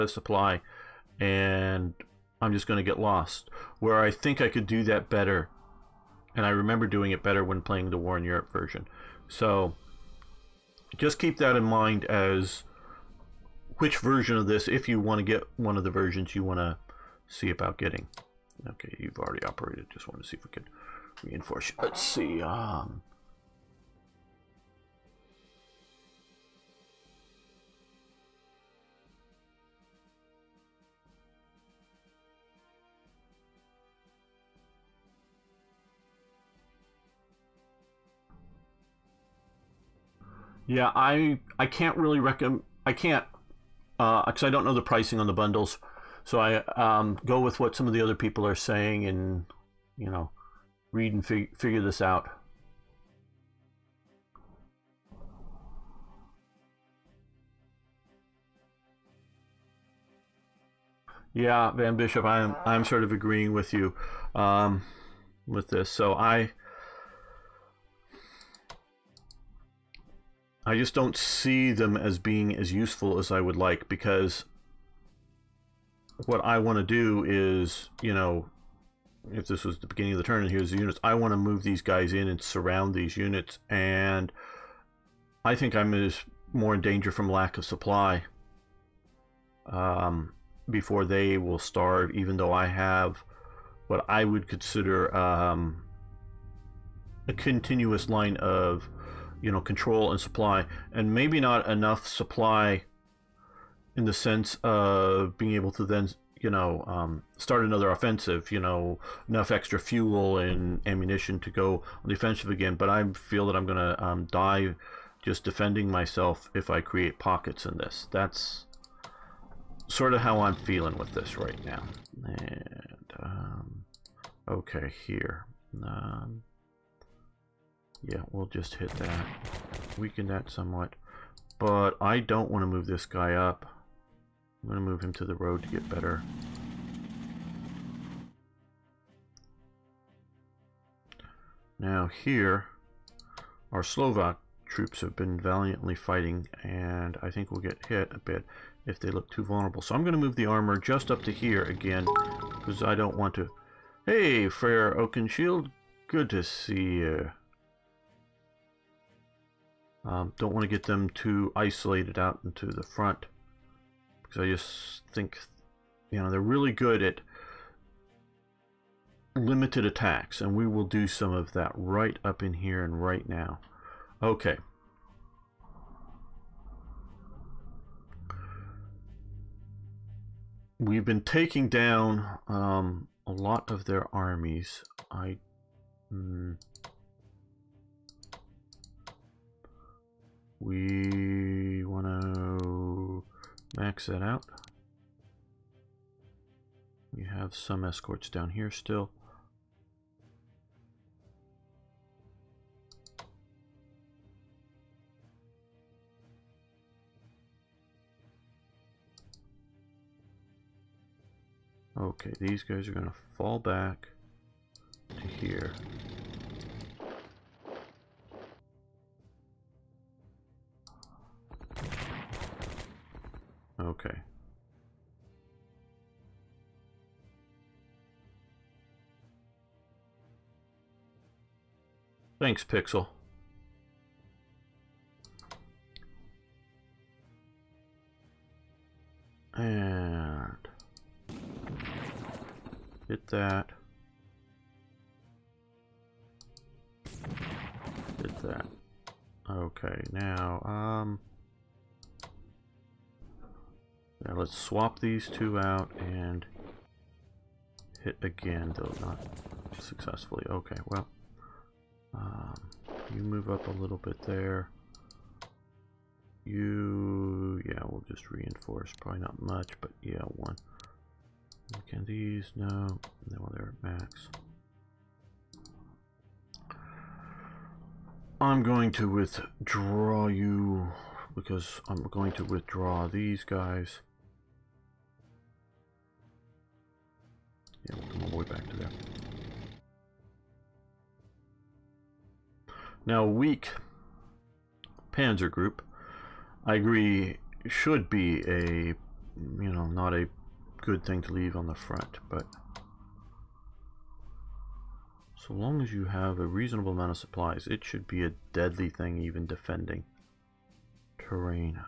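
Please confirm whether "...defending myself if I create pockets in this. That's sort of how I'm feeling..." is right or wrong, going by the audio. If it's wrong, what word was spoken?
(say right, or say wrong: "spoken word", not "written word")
right.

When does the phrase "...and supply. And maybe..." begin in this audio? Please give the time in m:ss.
1:40.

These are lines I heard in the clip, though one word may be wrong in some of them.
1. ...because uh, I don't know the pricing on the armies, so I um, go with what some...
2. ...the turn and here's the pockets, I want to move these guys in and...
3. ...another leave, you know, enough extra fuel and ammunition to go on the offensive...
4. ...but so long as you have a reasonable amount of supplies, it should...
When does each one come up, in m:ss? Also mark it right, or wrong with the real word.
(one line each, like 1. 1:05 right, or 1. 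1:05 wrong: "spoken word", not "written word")
1. 0:43 wrong: "bundles", not "armies"
2. 1:20 wrong: "units", not "pockets"
3. 1:47 wrong: "offensive", not "leave"
4. 5:02 right.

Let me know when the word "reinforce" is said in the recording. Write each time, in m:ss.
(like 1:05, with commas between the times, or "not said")
0:21, 4:28.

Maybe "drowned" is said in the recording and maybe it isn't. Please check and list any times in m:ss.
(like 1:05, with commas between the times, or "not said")
not said.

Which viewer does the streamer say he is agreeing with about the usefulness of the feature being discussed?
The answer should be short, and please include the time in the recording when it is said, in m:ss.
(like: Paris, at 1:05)
Van Bishop, at 1:01.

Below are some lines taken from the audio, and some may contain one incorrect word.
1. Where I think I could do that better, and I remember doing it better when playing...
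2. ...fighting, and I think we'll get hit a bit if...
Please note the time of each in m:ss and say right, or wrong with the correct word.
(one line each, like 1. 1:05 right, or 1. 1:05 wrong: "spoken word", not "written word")
1. 0:03 right
2. 2:25 right.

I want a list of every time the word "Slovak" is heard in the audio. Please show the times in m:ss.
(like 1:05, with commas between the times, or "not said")
2:23.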